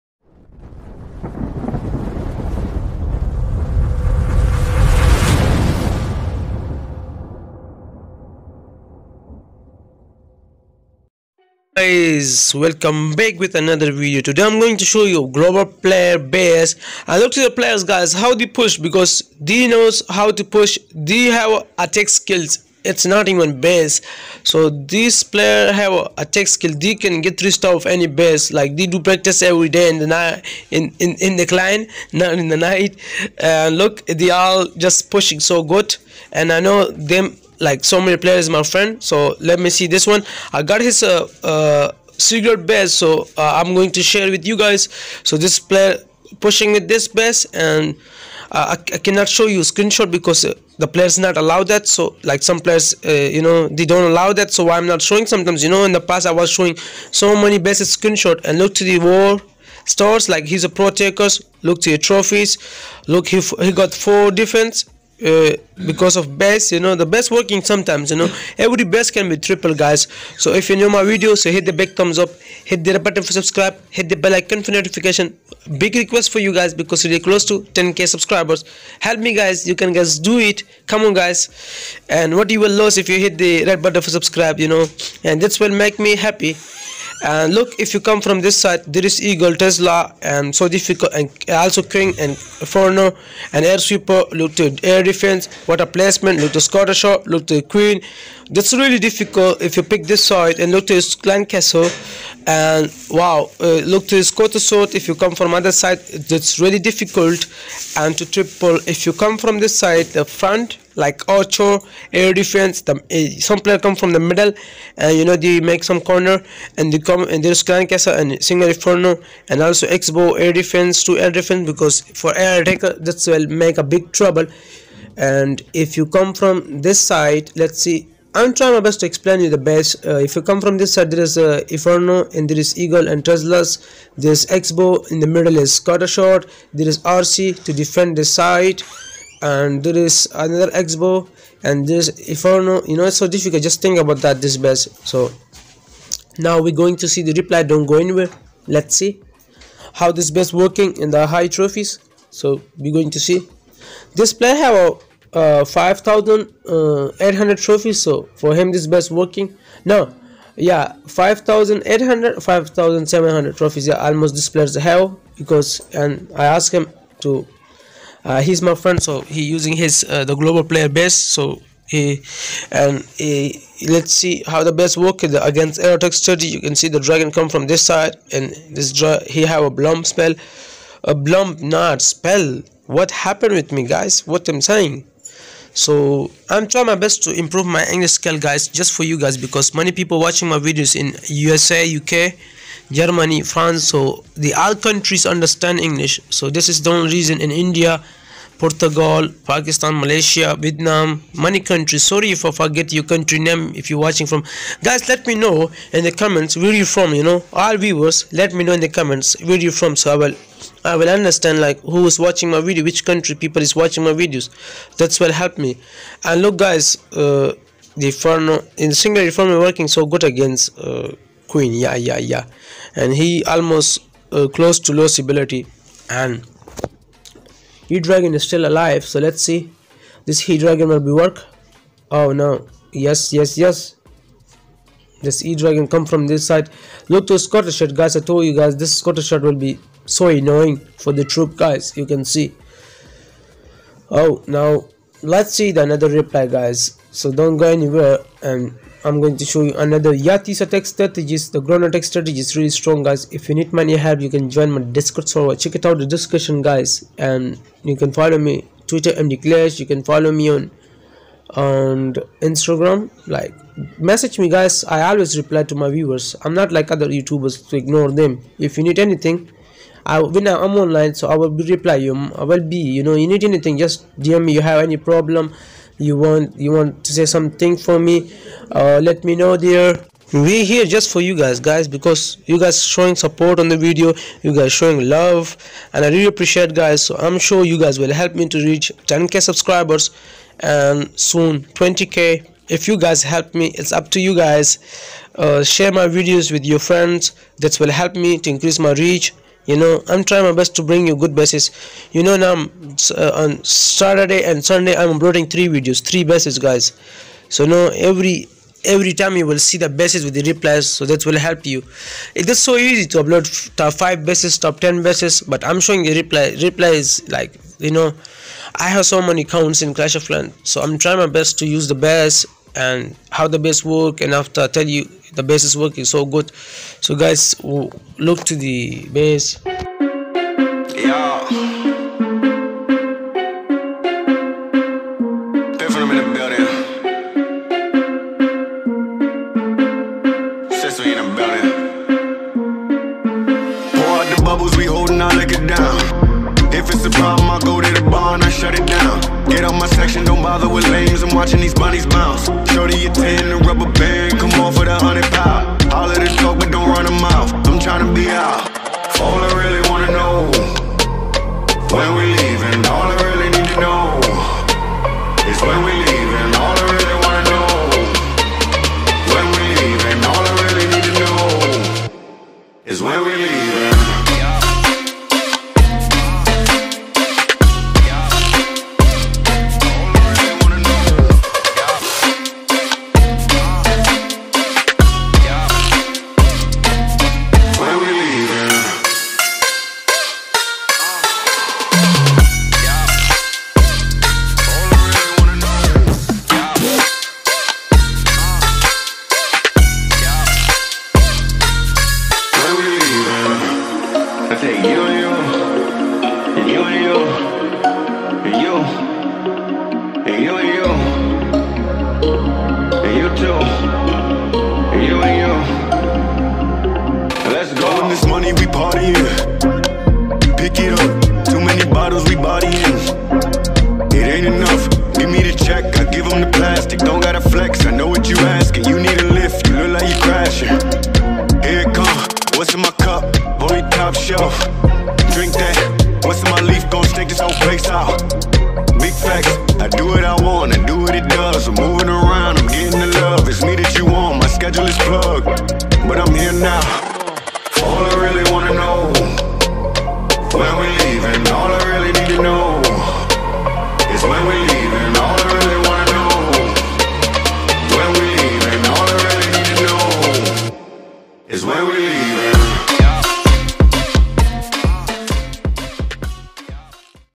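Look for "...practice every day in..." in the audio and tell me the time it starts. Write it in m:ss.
0:28.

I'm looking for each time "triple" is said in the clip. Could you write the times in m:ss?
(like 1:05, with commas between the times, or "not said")
1:09, 1:48.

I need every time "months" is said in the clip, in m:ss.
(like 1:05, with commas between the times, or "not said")
not said.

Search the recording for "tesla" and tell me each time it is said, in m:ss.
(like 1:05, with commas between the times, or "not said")
1:29, 2:13.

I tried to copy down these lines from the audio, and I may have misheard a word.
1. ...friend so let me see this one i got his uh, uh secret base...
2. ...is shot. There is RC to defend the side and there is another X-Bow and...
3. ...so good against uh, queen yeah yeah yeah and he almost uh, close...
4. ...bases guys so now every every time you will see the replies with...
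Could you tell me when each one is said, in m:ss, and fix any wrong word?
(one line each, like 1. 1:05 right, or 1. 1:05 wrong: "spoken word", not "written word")
1. 0:38 right
2. 2:15 right
3. 3:39 right
4. 5:06 wrong: "bases", not "replies".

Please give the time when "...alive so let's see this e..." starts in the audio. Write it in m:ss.
3:48.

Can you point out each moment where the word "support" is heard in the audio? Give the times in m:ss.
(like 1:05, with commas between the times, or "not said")
4:43.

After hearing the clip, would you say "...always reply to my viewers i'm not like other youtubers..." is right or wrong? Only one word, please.
right.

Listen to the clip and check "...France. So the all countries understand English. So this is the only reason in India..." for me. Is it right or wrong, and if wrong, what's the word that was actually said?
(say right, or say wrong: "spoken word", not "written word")
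right.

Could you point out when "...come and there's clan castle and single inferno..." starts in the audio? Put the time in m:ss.
1:56.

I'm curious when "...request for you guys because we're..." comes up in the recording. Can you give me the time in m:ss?
1:15.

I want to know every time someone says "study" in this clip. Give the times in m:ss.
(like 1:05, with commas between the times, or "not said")
2:56.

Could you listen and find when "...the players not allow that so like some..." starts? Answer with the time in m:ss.
0:50.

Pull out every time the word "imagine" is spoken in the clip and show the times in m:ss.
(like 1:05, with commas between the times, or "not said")
not said.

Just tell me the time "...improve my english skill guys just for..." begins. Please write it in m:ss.
3:07.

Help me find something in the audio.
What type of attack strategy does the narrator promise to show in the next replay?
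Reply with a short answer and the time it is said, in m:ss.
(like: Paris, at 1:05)
Yeti, at 4:10.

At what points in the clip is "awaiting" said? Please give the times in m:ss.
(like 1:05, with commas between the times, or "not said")
not said.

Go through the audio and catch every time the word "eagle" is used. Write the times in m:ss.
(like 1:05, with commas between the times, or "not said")
1:29, 2:12.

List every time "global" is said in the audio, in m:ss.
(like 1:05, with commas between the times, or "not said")
0:15, 2:50.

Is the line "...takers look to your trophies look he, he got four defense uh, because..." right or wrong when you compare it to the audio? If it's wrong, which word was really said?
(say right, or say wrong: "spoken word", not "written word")
right.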